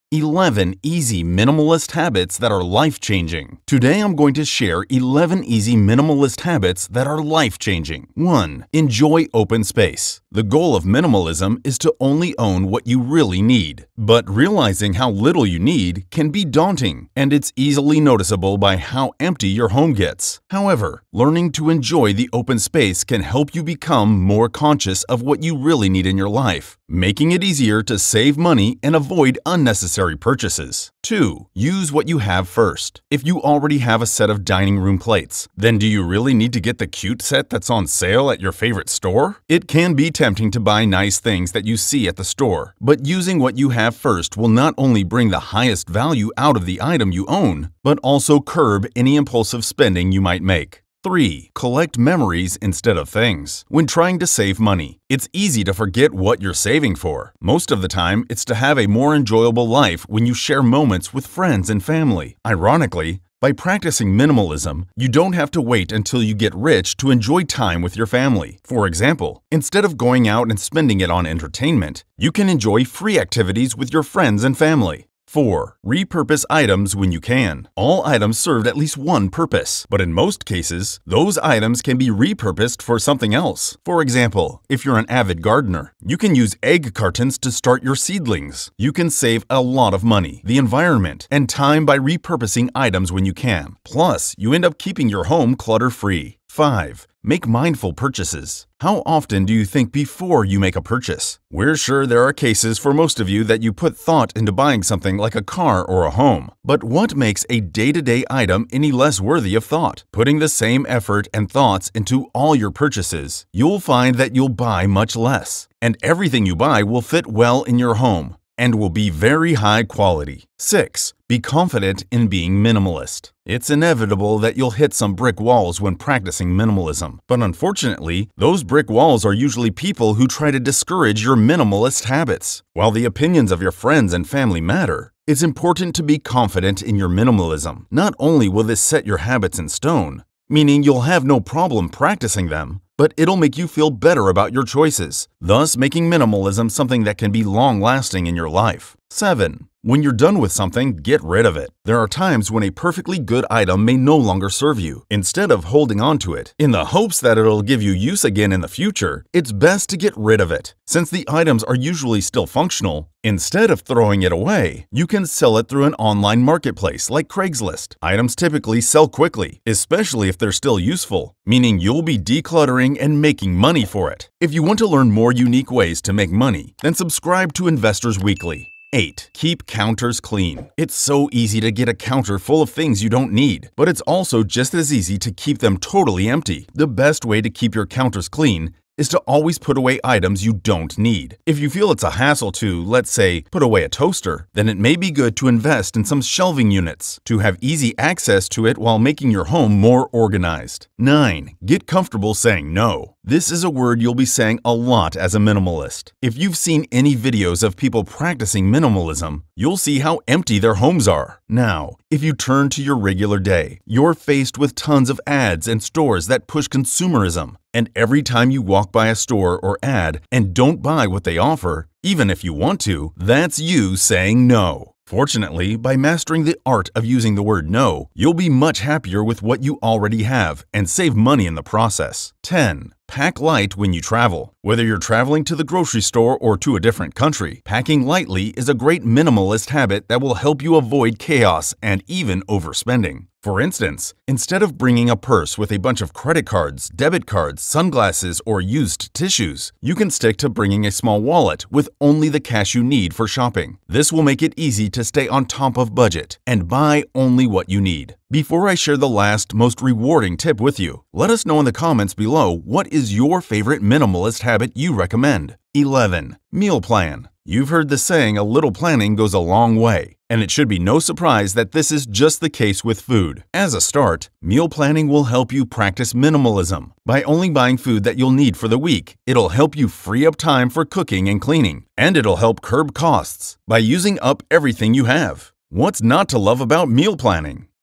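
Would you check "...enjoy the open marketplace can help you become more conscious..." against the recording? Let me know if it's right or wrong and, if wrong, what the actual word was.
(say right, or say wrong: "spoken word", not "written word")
wrong: "space", not "marketplace".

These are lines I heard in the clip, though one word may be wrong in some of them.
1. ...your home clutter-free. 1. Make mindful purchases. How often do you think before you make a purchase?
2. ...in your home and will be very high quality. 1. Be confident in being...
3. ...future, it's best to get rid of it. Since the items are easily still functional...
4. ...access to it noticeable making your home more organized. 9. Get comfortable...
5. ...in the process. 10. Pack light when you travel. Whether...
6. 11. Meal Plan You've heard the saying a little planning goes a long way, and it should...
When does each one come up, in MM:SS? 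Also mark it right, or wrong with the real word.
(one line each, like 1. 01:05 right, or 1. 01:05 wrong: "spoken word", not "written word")
1. 01:35 wrong: "5", not "1"
2. 01:57 wrong: "6", not "1"
3. 02:38 wrong: "usually", not "easily"
4. 03:17 wrong: "while", not "noticeable"
5. 03:51 right
6. 04:25 right.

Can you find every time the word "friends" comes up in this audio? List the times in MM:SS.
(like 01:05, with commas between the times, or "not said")
01:01, 01:14, 02:13.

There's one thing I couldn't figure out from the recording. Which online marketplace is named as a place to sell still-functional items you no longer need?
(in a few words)
Craigslist.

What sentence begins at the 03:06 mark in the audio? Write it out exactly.
The best way to keep your counters clean is to always put away items you don't need.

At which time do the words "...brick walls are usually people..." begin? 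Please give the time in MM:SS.
02:08.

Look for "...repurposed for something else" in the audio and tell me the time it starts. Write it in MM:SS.
01:22.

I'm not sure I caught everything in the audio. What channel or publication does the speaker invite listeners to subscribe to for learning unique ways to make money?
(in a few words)
Investors Weekly.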